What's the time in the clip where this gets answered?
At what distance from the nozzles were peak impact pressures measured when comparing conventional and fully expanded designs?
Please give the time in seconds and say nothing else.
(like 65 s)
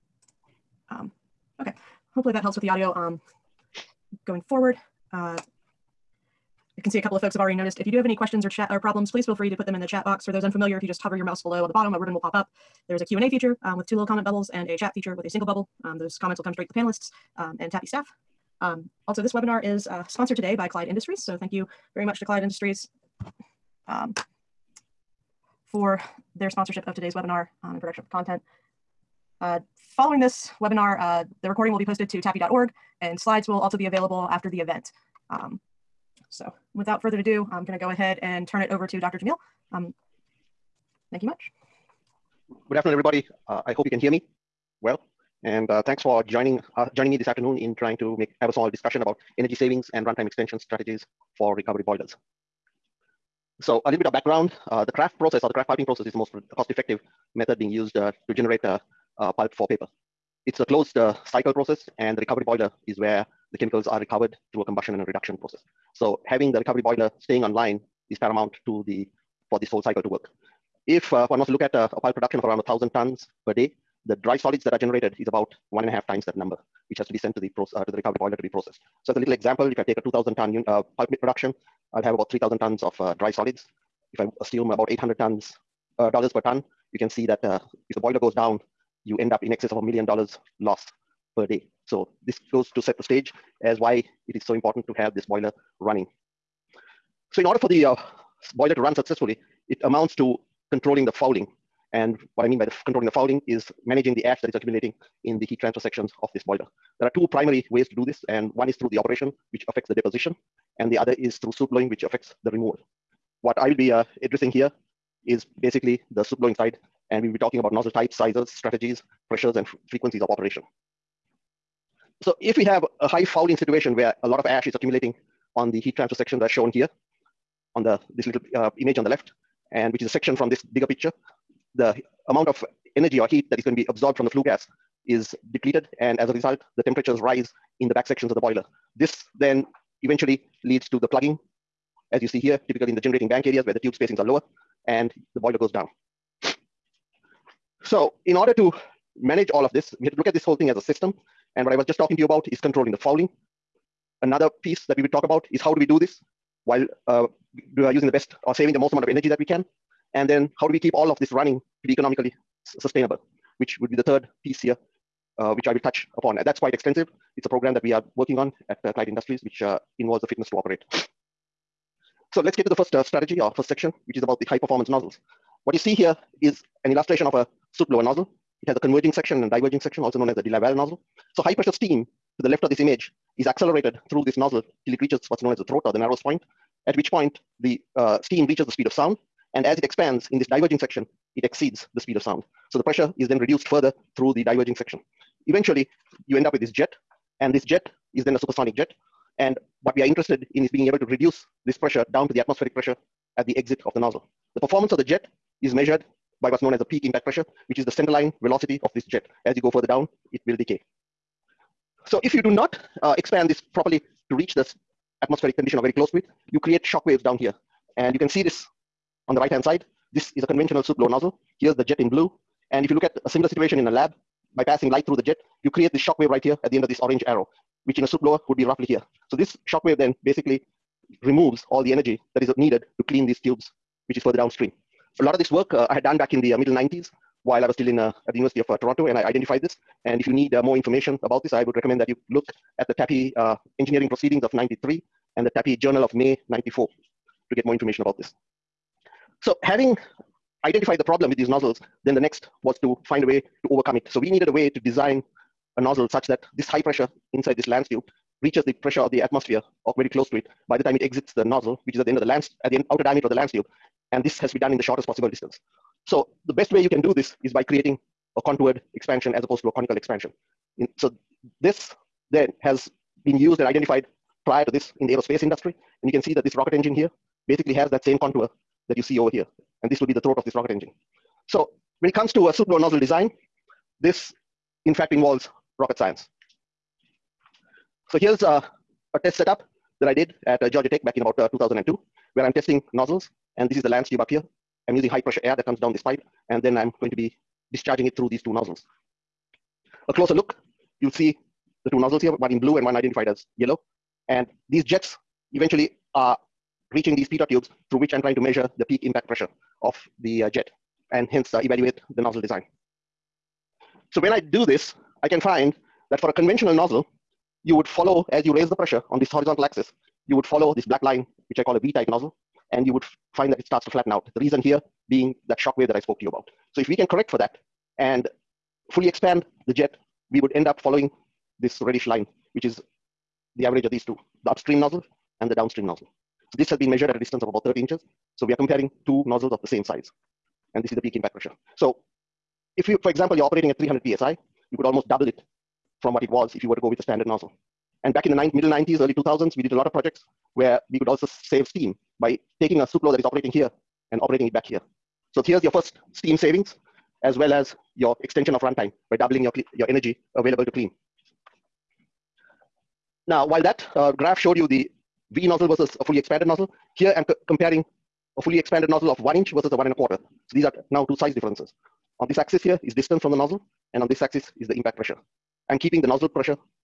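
337 s.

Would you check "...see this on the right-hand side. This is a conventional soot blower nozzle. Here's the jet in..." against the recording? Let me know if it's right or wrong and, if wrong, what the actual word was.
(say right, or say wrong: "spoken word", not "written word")
right.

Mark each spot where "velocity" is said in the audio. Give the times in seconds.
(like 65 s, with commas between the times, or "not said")
208 s.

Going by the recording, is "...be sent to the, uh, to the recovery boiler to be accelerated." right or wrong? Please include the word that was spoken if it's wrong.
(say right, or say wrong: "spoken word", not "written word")
wrong: "processed", not "accelerated".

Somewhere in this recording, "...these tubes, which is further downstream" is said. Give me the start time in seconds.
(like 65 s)
233 s.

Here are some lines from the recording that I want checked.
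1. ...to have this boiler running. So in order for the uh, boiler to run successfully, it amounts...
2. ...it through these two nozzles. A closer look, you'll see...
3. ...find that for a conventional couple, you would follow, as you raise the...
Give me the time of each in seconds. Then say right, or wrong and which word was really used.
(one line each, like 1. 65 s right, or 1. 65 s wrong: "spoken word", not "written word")
1. 94 s right
2. 298 s right
3. 315 s wrong: "nozzle", not "couple".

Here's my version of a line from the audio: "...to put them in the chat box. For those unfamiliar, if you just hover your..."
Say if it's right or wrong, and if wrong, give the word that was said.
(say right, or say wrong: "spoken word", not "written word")
right.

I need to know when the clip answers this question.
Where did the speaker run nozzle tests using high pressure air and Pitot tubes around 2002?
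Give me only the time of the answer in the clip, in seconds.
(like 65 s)
290 s.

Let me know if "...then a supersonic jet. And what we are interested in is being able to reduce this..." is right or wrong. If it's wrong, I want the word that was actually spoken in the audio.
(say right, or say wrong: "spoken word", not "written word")
right.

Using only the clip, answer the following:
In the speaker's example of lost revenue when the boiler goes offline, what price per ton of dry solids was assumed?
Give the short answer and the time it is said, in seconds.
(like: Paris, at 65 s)
800 dollars, at 84 s.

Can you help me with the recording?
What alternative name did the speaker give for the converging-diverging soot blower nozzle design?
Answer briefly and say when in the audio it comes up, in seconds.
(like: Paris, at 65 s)
de Laval nozzle, at 180 s.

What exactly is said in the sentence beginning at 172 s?
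So let's get to the first uh, strategy or uh, first section, which is about the high performance nozzles.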